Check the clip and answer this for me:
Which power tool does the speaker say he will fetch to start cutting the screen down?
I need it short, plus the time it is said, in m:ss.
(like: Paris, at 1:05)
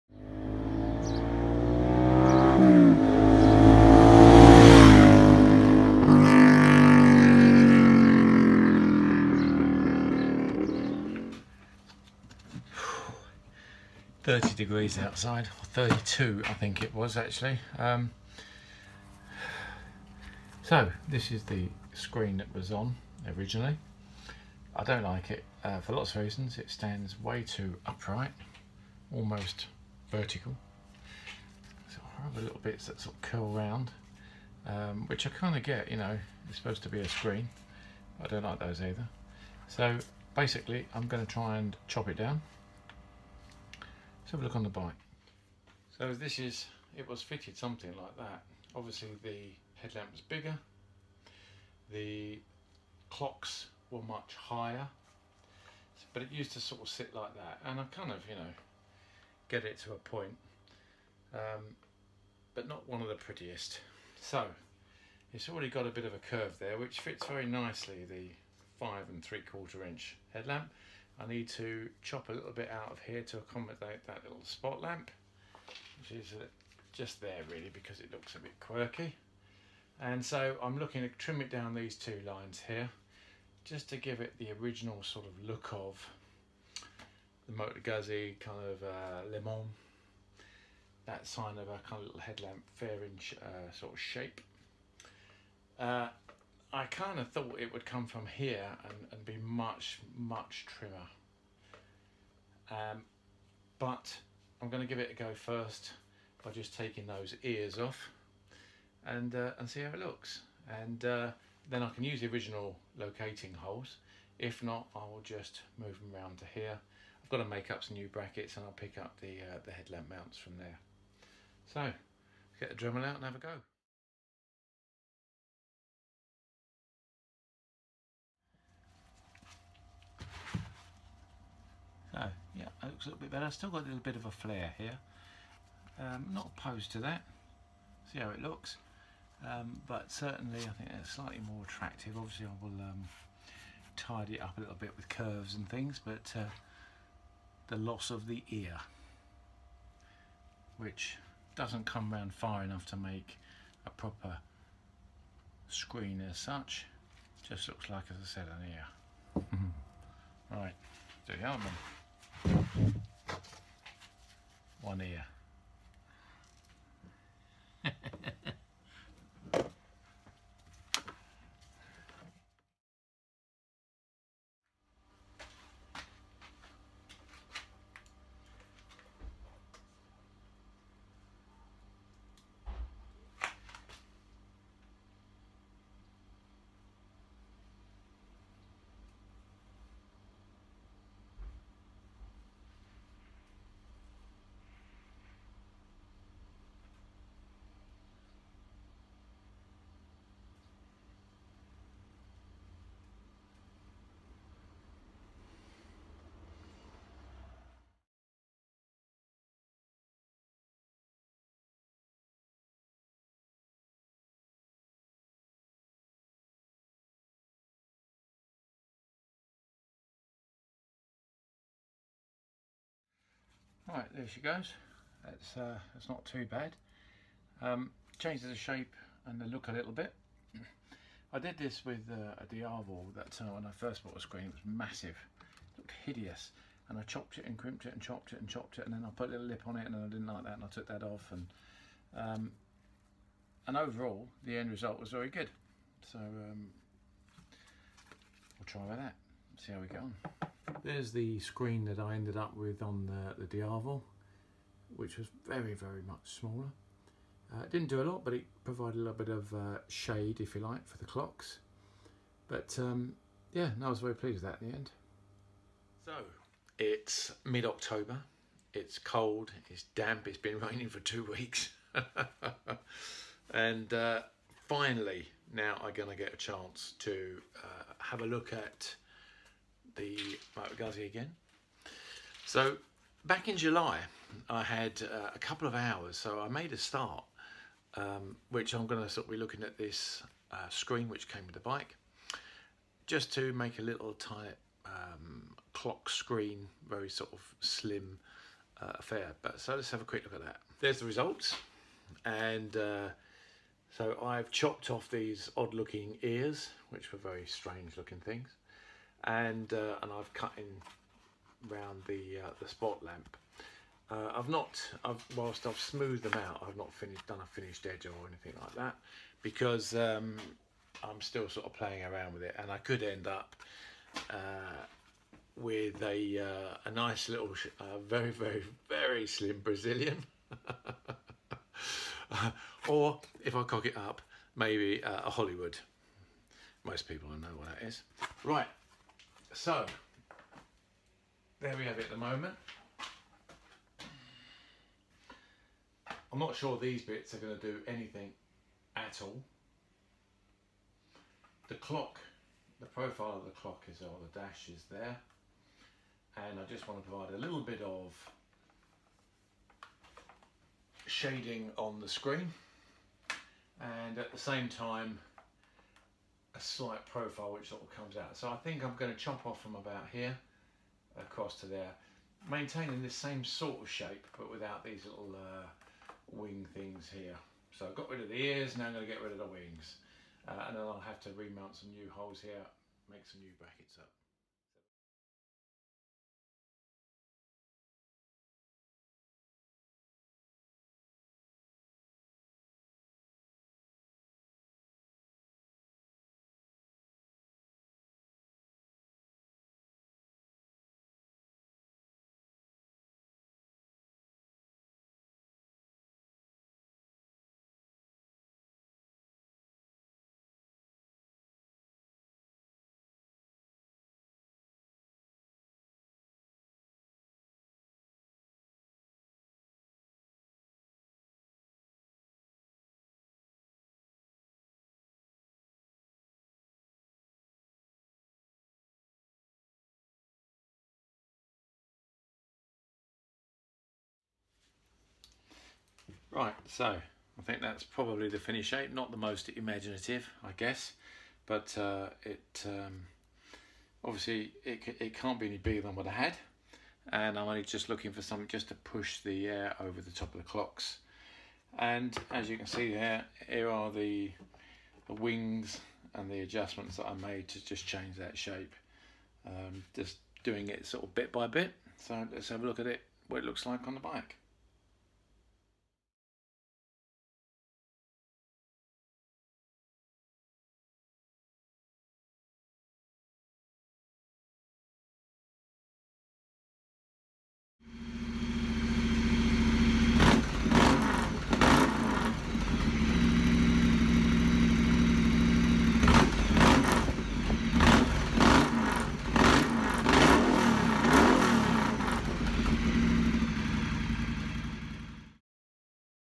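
Dremel, at 2:02.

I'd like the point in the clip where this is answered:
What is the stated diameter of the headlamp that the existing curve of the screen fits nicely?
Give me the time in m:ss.
1:08.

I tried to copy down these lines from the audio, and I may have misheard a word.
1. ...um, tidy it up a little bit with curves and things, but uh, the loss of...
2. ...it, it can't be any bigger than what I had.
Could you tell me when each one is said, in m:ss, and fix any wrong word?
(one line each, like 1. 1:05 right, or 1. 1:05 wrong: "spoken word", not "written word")
1. 2:22 right
2. 7:24 right.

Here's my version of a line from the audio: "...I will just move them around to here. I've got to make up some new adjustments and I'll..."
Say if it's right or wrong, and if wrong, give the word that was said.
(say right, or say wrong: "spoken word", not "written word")
wrong: "brackets", not "adjustments".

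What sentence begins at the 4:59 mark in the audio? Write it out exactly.
But so let's have a quick look at that.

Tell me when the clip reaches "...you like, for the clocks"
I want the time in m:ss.
4:20.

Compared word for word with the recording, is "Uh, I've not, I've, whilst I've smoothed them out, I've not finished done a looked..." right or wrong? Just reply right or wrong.
wrong.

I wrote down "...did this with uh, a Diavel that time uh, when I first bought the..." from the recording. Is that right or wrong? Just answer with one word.
right.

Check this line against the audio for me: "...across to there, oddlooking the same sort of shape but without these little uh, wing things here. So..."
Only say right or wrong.
wrong.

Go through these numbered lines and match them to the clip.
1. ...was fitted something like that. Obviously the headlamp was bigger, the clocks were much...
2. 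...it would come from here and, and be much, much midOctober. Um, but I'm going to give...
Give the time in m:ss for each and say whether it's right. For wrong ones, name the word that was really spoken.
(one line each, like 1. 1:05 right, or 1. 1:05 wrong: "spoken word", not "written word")
1. 0:47 right
2. 1:37 wrong: "trimmer", not "midOctober".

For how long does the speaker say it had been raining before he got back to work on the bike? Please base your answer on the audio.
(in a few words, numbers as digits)
two weeks.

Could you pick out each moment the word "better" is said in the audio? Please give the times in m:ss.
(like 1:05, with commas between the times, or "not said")
2:13.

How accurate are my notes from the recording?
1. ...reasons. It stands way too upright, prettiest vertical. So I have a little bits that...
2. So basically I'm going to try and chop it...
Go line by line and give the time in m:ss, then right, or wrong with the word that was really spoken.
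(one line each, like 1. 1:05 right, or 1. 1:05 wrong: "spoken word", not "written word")
1. 0:26 wrong: "almost", not "prettiest"
2. 0:39 right.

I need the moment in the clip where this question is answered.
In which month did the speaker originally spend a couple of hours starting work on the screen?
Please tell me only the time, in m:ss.
4:43.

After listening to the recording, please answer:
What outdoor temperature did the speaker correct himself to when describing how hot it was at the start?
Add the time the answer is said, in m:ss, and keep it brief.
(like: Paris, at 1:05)
32 degrees, at 0:15.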